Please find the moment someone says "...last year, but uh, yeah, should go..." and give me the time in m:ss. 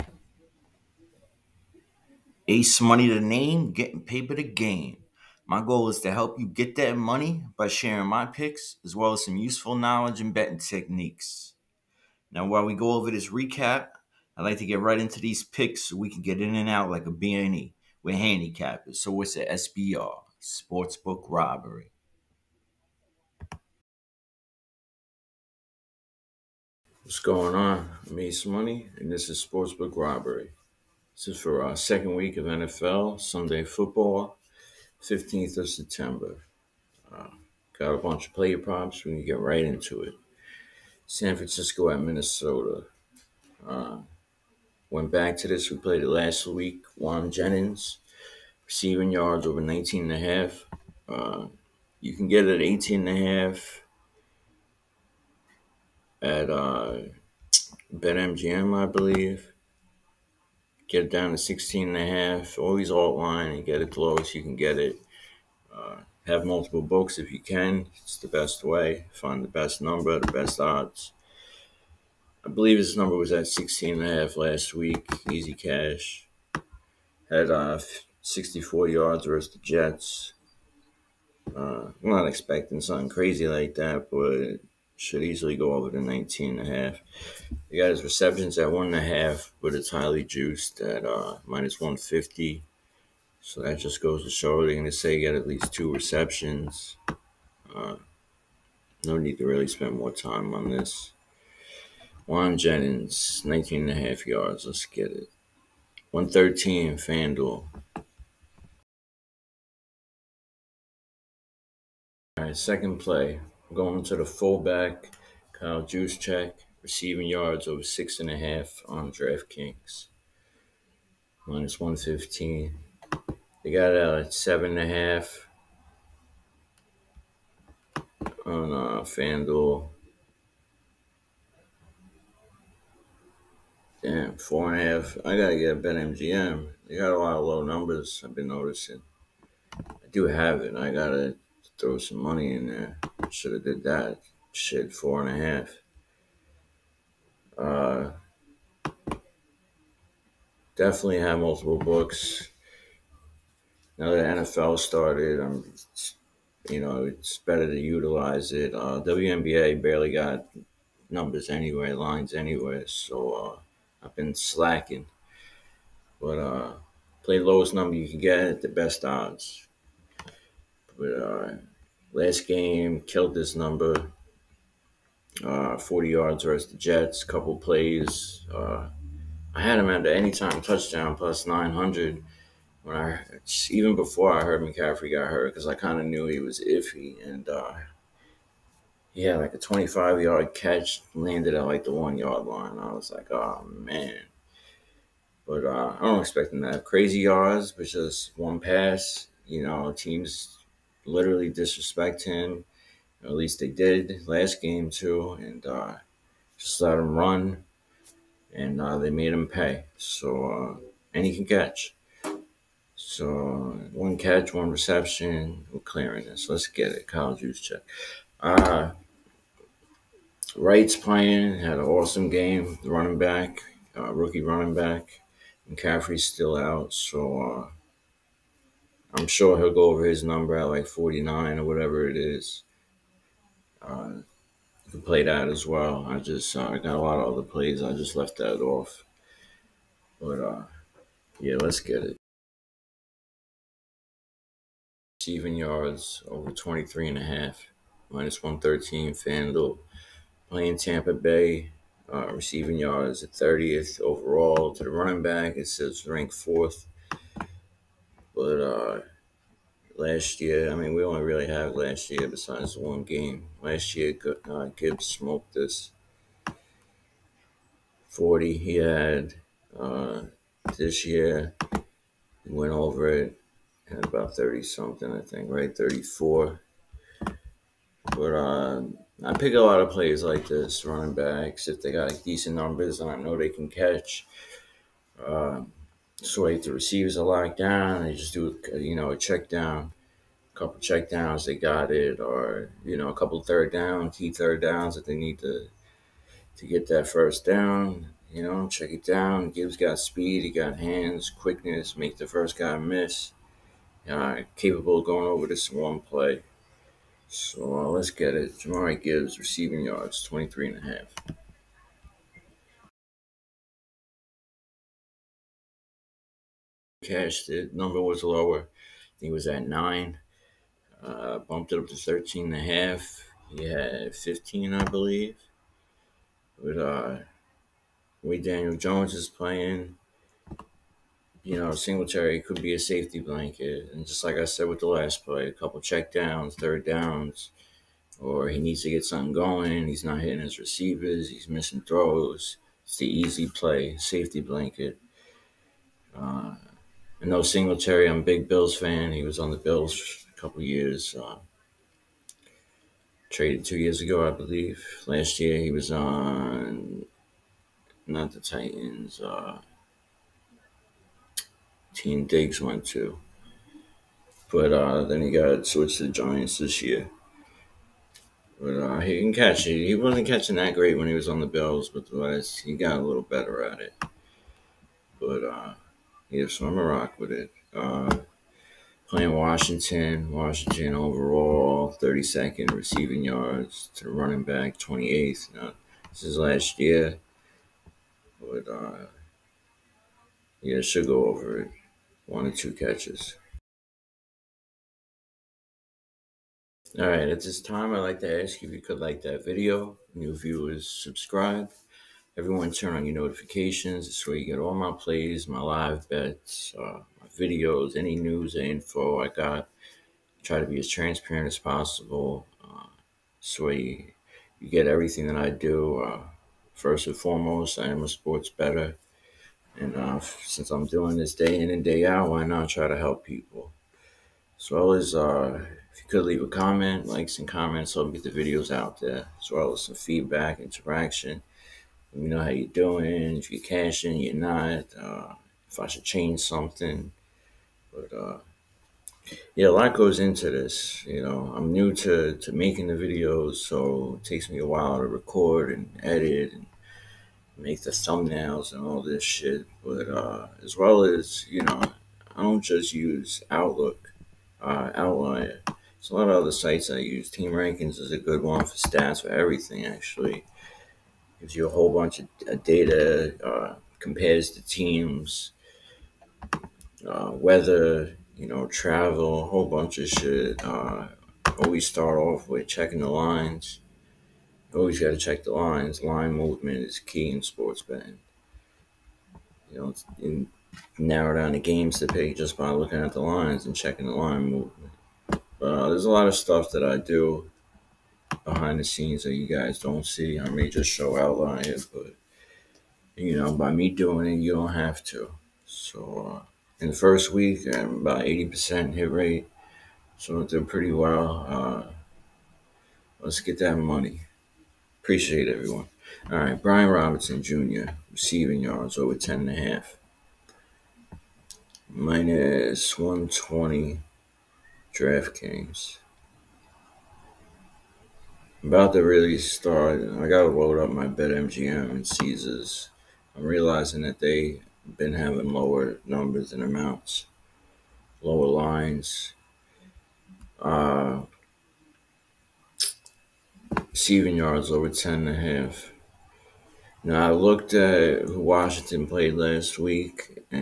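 6:26.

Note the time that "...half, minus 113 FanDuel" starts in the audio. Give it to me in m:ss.
4:07.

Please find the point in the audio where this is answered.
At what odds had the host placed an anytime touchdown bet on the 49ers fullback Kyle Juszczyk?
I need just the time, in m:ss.
3:01.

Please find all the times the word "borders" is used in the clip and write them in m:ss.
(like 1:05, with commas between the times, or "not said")
not said.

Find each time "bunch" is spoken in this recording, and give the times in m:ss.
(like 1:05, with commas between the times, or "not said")
0:37, 7:41, 7:49.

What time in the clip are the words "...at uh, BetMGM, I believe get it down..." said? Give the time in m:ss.
0:56.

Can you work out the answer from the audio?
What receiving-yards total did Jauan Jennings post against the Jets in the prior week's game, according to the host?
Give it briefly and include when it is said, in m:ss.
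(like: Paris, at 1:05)
64, at 1:18.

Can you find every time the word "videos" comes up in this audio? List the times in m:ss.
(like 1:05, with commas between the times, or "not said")
6:39, 6:47, 7:08, 7:22.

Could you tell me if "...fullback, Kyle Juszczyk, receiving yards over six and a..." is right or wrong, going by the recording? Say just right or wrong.
right.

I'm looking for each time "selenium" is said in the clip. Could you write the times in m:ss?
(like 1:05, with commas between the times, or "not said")
not said.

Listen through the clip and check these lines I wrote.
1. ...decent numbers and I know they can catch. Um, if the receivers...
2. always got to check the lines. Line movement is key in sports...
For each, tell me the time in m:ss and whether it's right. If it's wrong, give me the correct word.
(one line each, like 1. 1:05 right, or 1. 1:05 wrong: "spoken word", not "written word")
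1. 4:42 right
2. 7:54 right.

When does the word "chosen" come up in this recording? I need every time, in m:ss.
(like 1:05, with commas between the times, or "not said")
not said.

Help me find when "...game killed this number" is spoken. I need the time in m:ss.
2:52.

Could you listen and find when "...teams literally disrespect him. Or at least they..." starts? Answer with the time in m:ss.
3:19.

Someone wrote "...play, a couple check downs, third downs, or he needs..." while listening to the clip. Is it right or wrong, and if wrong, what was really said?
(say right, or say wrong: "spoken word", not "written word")
right.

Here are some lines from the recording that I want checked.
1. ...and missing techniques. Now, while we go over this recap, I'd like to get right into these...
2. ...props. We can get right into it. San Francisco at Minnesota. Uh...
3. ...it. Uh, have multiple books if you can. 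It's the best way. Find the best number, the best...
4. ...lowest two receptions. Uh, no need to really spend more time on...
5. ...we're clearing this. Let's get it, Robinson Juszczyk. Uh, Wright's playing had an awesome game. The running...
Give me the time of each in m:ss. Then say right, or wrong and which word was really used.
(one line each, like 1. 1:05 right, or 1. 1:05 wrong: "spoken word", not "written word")
1. 0:10 wrong: "betting", not "missing"
2. 0:38 right
3. 1:04 right
4. 1:35 wrong: "least", not "lowest"
5. 3:35 wrong: "Kyle", not "Robinson".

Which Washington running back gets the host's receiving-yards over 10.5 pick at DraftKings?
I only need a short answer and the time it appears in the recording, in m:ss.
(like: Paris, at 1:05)
Brian Robinson Jr., at 8:26.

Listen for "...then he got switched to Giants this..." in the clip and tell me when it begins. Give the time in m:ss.
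6:05.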